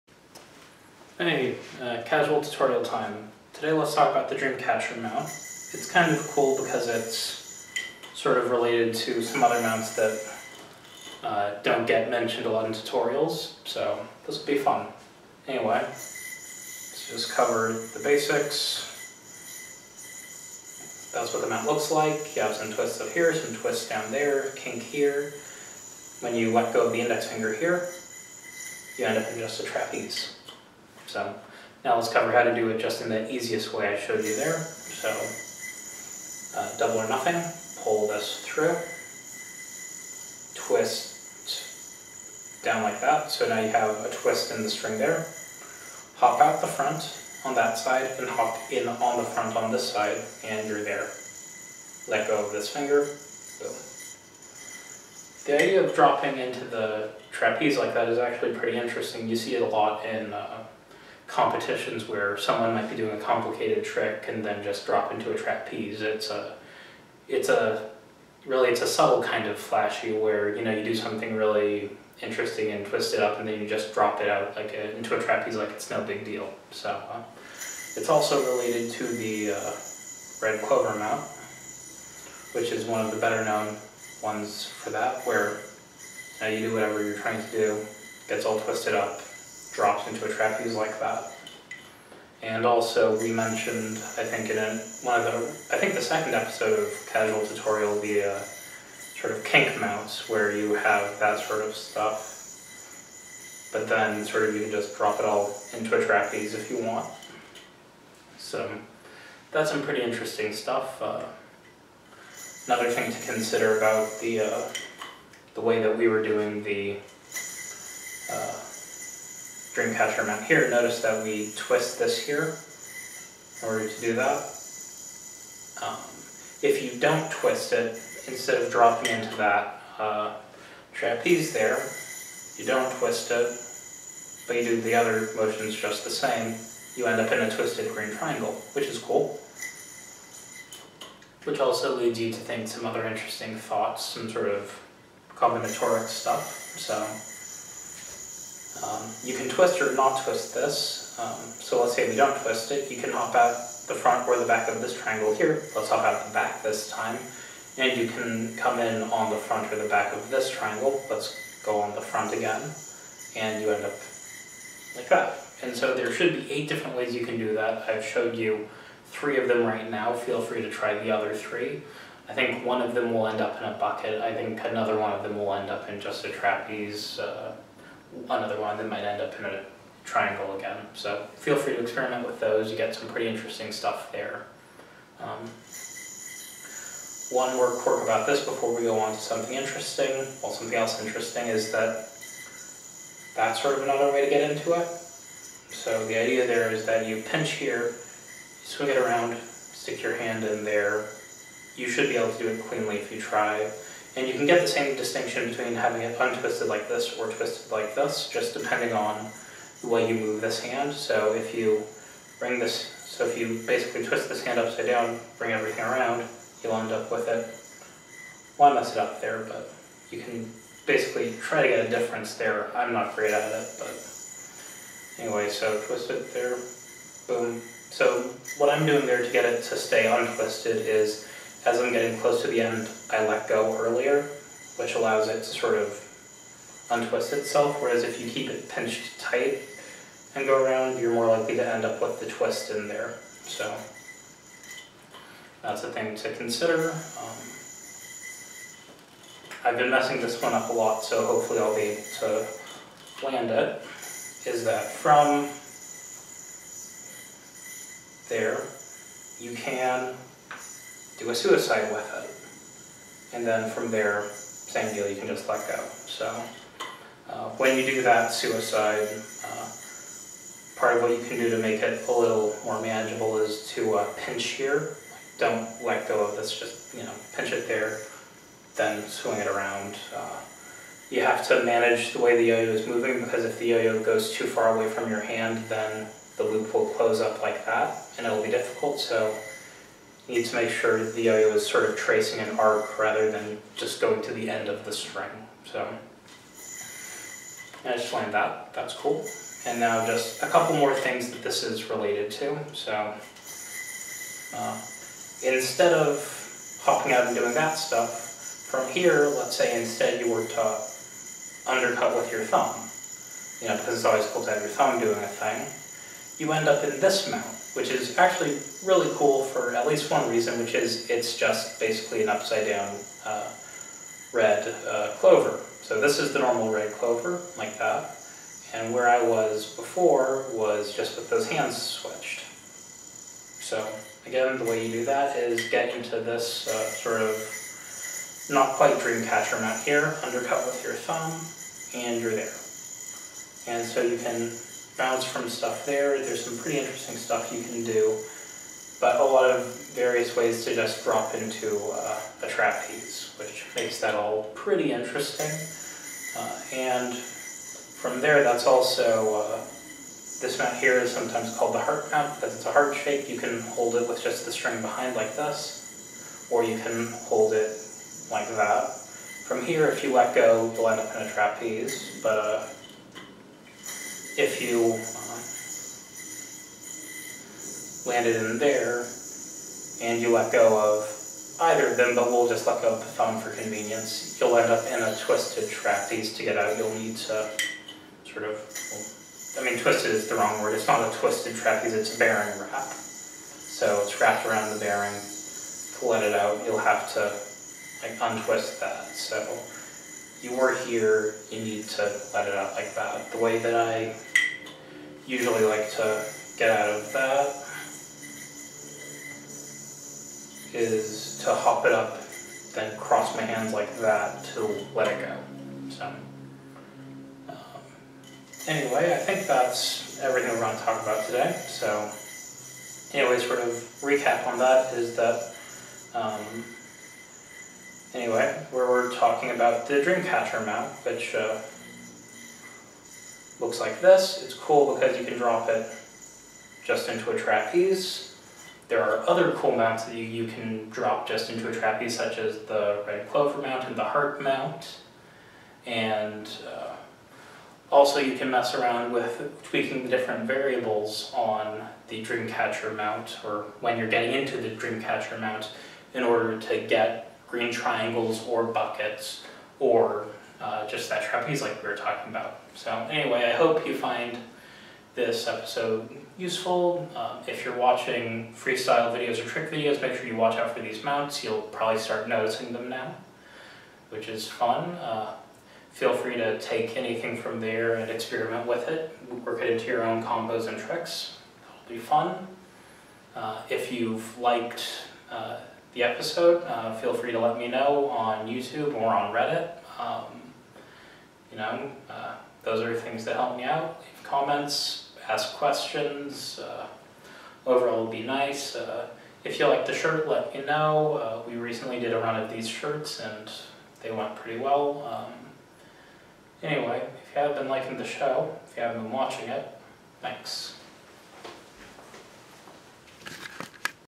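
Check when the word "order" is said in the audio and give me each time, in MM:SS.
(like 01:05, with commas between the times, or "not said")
02:03, 07:36.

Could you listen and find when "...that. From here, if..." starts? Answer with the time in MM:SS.
06:08.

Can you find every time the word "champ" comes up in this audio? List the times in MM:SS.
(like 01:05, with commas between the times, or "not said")
not said.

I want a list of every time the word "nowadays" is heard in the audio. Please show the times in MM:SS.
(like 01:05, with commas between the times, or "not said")
not said.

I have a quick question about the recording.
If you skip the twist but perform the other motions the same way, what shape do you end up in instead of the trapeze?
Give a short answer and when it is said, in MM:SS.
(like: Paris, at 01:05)
twisted green triangle, at 02:17.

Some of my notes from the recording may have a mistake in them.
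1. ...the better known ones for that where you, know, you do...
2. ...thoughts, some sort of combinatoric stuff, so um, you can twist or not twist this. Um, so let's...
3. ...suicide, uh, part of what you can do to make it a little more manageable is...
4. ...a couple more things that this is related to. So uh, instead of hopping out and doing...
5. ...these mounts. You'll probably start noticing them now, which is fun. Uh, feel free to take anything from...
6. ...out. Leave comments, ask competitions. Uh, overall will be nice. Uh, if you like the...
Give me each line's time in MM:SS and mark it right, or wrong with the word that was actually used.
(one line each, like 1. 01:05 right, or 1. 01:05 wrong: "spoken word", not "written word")
1. 01:23 right
2. 02:23 right
3. 04:28 right
4. 05:00 right
5. 07:50 right
6. 08:13 wrong: "questions", not "competitions".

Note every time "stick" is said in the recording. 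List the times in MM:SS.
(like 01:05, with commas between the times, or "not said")
03:19.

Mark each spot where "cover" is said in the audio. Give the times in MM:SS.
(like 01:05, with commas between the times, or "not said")
00:17, 00:32.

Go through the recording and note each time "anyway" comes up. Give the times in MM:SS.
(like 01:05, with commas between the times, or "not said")
00:15, 03:45, 06:58, 07:03, 07:08, 07:43, 08:26.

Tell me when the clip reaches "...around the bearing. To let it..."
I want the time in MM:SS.
06:34.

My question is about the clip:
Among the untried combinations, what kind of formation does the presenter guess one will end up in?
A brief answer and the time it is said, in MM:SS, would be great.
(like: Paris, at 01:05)
bucket, at 02:53.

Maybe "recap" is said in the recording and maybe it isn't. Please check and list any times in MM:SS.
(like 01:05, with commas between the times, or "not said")
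07:04.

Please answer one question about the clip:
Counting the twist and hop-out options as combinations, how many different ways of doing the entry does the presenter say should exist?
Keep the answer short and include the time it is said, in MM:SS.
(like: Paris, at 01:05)
8, at 02:46.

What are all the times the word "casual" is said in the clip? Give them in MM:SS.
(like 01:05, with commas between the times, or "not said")
00:02, 01:37.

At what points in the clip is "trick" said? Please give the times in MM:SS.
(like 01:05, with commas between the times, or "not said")
01:03, 07:49, 08:00.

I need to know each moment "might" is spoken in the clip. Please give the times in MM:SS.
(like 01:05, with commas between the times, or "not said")
01:02, 02:58.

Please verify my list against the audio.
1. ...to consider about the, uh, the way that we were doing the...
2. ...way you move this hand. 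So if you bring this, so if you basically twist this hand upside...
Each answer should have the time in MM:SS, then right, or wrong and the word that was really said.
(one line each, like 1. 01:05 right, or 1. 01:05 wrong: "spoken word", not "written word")
1. 01:53 right
2. 03:29 right.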